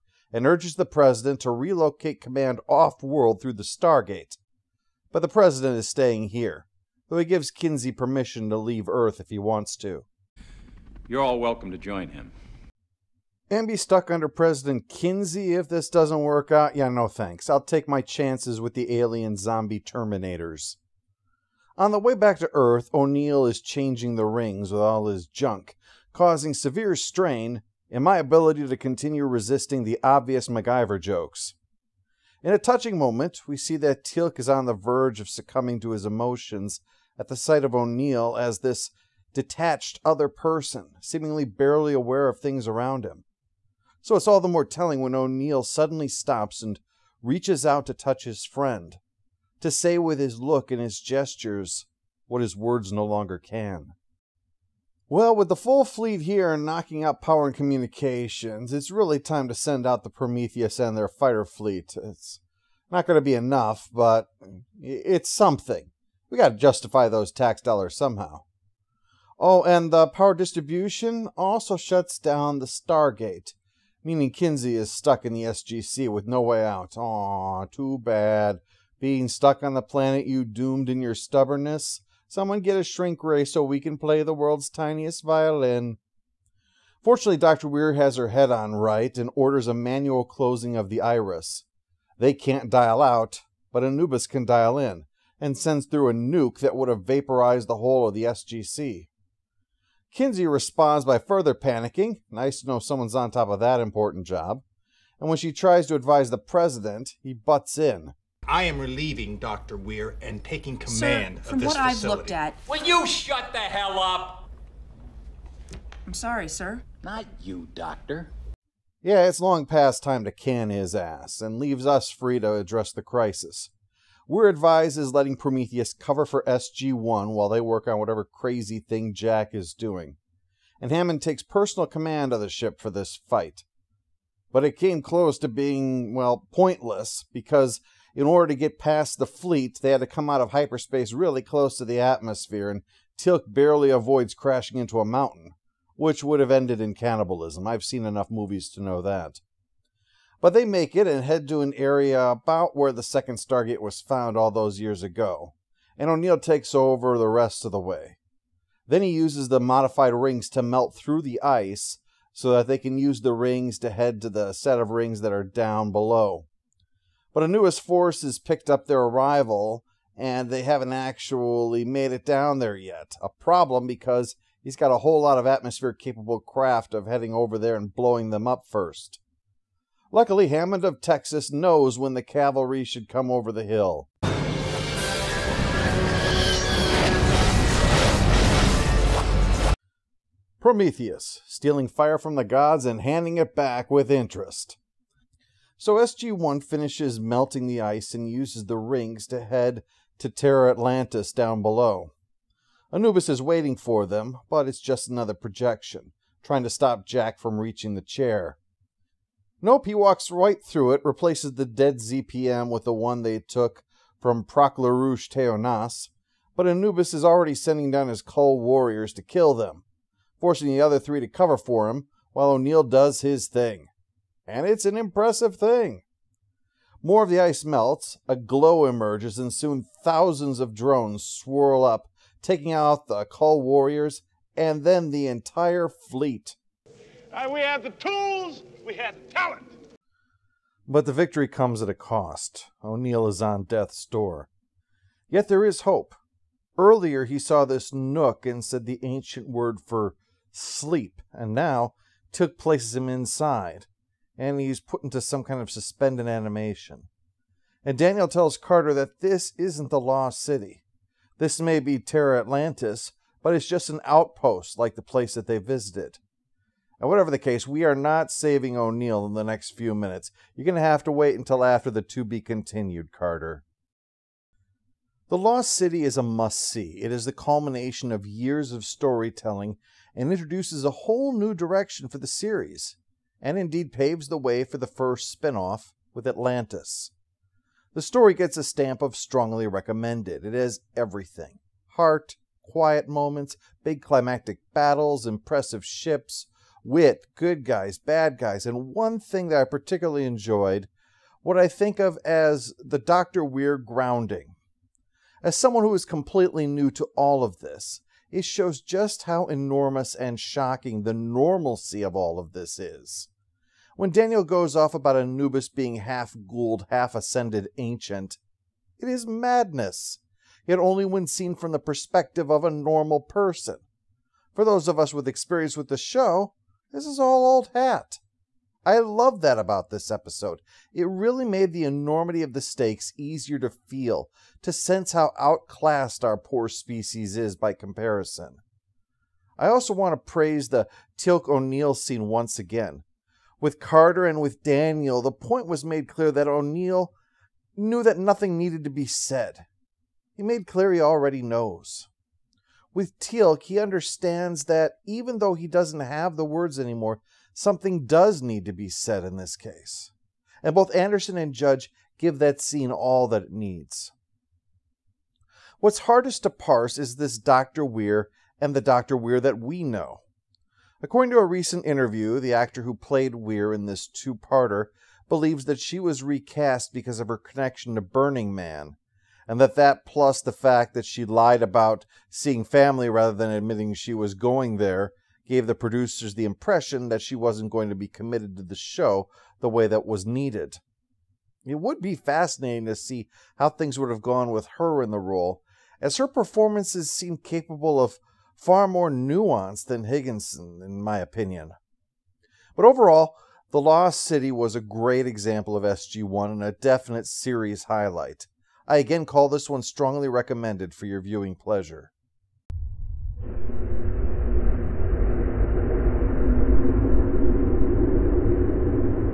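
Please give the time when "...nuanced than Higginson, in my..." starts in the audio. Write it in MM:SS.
06:39.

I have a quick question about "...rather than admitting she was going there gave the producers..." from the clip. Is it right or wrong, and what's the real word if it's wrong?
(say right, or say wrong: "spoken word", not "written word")
right.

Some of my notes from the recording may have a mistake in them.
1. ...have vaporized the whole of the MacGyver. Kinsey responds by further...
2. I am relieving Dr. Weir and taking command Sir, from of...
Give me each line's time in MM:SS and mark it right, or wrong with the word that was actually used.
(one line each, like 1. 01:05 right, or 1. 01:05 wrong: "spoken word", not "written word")
1. 01:36 wrong: "SGC", not "MacGyver"
2. 01:48 right.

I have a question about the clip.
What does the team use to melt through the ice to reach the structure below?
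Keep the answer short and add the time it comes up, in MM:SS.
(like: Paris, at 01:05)
modified rings, at 02:39.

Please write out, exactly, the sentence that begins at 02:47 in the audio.
But Anubis' force has picked up their arrival, and they haven't actually made it down there yet.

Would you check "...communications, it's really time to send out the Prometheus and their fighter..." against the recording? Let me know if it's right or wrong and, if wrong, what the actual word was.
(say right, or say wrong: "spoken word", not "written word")
right.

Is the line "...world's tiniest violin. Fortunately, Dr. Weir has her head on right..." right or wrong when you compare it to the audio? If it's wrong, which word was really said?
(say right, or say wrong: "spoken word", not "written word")
right.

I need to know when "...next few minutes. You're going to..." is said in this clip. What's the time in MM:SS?
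04:29.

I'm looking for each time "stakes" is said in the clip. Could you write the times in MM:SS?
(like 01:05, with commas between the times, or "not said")
05:32.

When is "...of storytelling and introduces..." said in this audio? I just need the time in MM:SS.
04:38.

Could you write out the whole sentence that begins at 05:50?
He made clear he already knows.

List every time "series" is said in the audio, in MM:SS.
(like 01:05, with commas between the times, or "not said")
04:42, 06:47.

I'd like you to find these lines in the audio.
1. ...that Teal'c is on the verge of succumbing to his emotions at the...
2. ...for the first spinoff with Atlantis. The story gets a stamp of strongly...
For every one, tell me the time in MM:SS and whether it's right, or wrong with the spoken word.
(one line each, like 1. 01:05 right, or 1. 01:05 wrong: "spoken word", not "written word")
1. 00:33 right
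2. 04:44 right.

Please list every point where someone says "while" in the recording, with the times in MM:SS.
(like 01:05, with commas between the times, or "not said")
02:07, 03:42.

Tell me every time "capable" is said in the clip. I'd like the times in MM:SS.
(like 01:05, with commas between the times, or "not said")
02:55, 06:37.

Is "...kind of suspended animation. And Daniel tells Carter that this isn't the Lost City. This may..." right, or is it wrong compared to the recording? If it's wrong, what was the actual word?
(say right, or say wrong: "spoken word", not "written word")
right.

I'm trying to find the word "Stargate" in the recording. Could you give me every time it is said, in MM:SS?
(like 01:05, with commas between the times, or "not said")
00:03, 01:12, 02:33.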